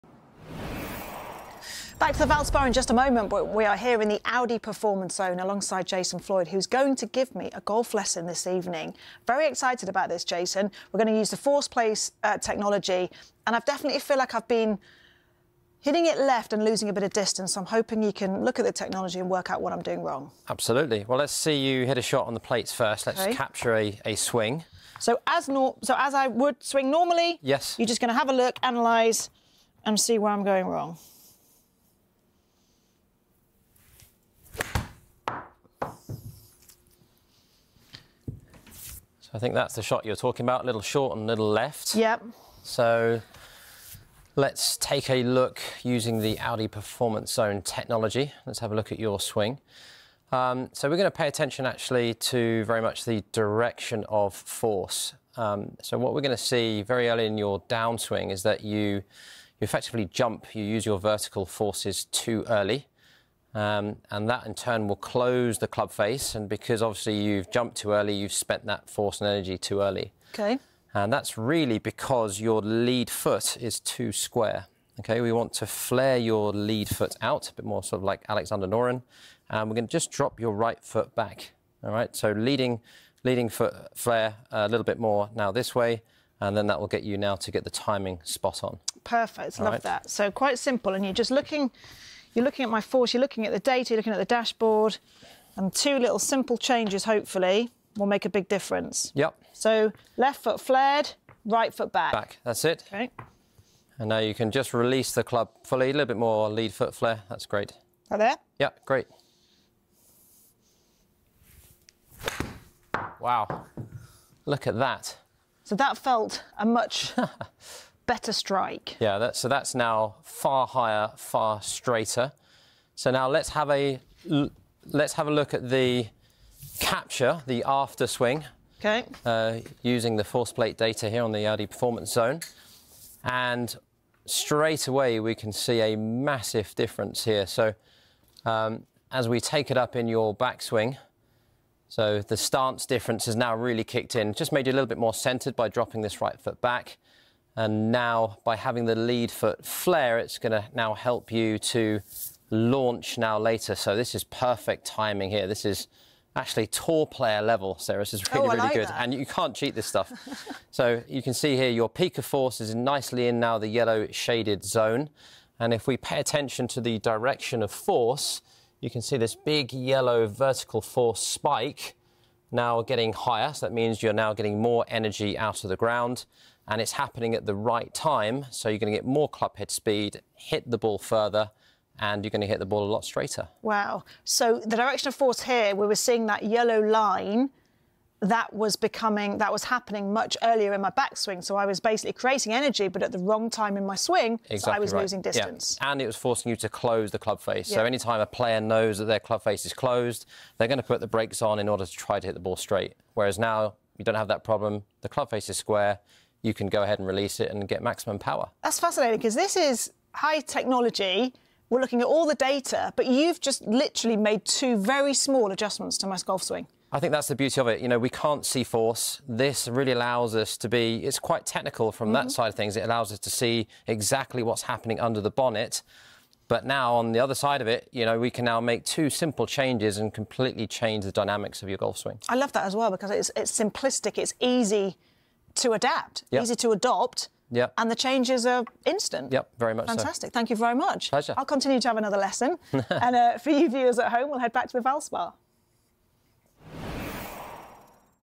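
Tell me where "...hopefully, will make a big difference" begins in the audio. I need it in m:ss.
1:37.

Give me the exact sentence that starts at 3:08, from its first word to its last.
That was becoming, that was happening much earlier in my backswing.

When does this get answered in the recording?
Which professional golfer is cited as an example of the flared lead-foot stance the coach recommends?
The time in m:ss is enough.
1:18.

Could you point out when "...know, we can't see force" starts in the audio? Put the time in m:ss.
3:37.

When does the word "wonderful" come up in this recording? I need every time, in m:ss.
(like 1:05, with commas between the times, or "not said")
not said.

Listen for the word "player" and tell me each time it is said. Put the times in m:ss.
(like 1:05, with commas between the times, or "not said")
2:37, 3:18.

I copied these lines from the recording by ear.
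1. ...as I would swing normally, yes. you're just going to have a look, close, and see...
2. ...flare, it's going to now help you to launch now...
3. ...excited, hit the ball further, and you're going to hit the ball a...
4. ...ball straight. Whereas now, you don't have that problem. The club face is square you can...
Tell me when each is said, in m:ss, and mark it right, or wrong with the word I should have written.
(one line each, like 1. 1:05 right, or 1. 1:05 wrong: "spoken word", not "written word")
1. 0:25 wrong: "analyse", not "close"
2. 2:29 right
3. 2:59 wrong: "speed", not "excited"
4. 3:22 right.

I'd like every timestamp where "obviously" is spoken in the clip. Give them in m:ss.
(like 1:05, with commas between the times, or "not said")
1:06.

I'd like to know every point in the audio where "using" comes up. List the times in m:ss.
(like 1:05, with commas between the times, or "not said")
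0:45, 2:09.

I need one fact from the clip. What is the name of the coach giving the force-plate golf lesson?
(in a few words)
Jason Floyd.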